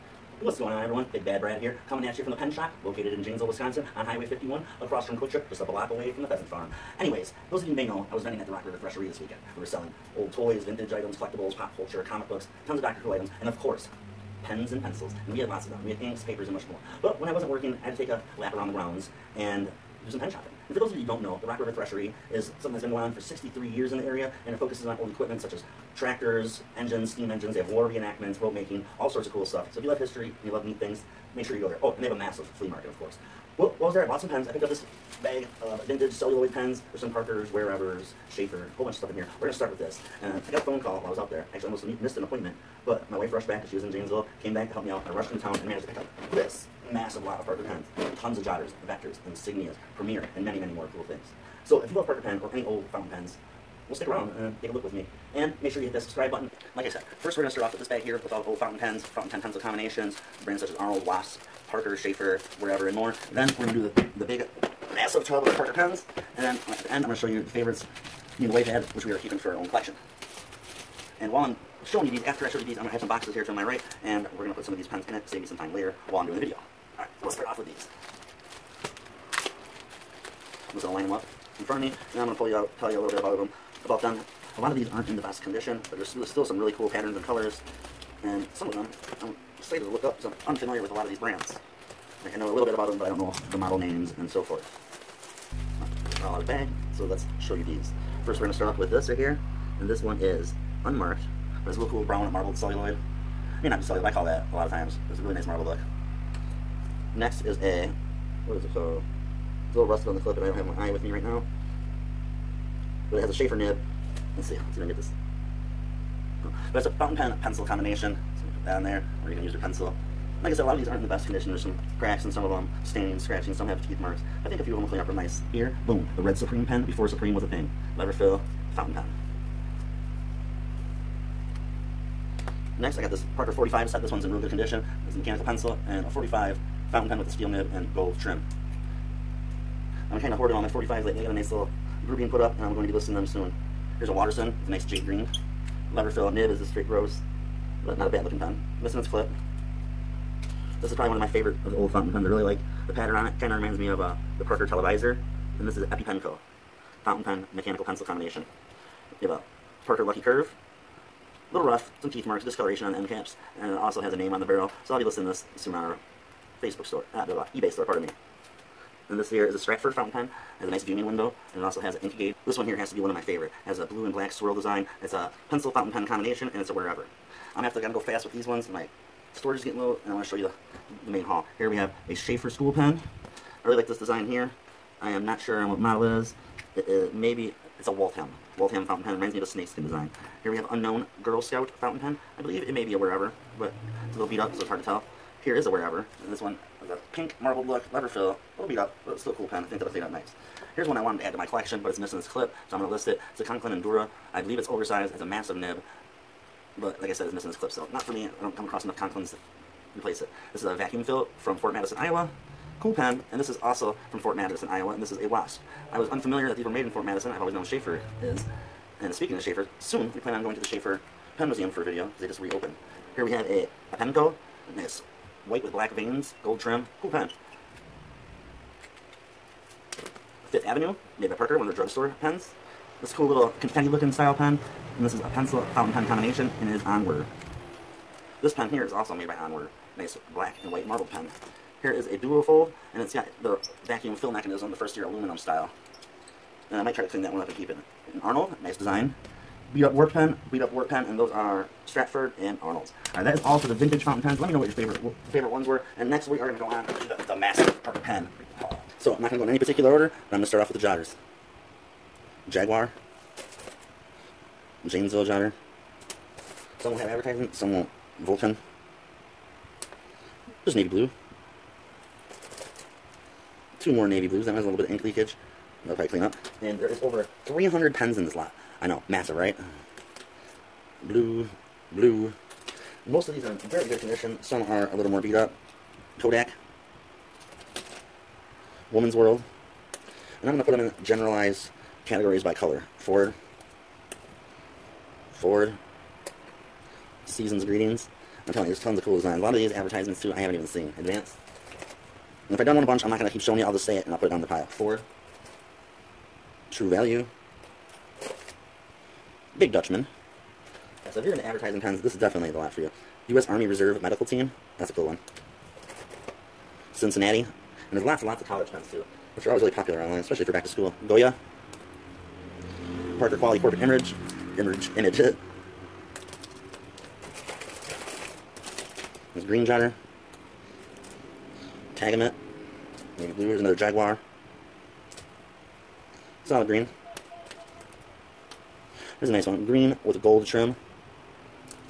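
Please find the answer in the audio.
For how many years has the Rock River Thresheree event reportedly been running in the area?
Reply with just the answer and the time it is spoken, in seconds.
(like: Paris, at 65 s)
63, at 23 s.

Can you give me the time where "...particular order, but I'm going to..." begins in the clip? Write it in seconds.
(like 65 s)
259 s.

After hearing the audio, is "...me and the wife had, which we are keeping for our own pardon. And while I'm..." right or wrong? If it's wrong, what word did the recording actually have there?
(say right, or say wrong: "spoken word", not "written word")
wrong: "collection", not "pardon".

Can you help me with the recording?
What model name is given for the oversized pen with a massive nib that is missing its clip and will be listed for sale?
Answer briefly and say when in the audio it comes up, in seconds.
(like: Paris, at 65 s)
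Conklin Endura, at 203 s.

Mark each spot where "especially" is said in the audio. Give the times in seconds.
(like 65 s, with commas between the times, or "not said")
320 s.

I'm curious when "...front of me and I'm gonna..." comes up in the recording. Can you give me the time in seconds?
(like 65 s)
81 s.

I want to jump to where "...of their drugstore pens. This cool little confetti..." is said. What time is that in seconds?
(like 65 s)
231 s.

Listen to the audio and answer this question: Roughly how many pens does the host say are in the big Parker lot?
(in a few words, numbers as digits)
over 300.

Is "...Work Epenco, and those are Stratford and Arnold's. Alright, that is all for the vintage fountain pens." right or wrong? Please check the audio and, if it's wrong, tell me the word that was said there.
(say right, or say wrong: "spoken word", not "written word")
wrong: "Pen", not "Epenco".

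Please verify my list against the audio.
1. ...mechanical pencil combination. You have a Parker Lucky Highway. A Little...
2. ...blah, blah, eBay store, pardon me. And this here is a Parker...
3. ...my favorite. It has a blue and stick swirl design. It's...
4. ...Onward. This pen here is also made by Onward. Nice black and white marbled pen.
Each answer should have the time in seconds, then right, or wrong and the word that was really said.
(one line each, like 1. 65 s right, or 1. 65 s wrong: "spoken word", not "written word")
1. 157 s wrong: "Curve", not "Highway"
2. 167 s wrong: "Stratford", not "Parker"
3. 173 s wrong: "black", not "stick"
4. 236 s right.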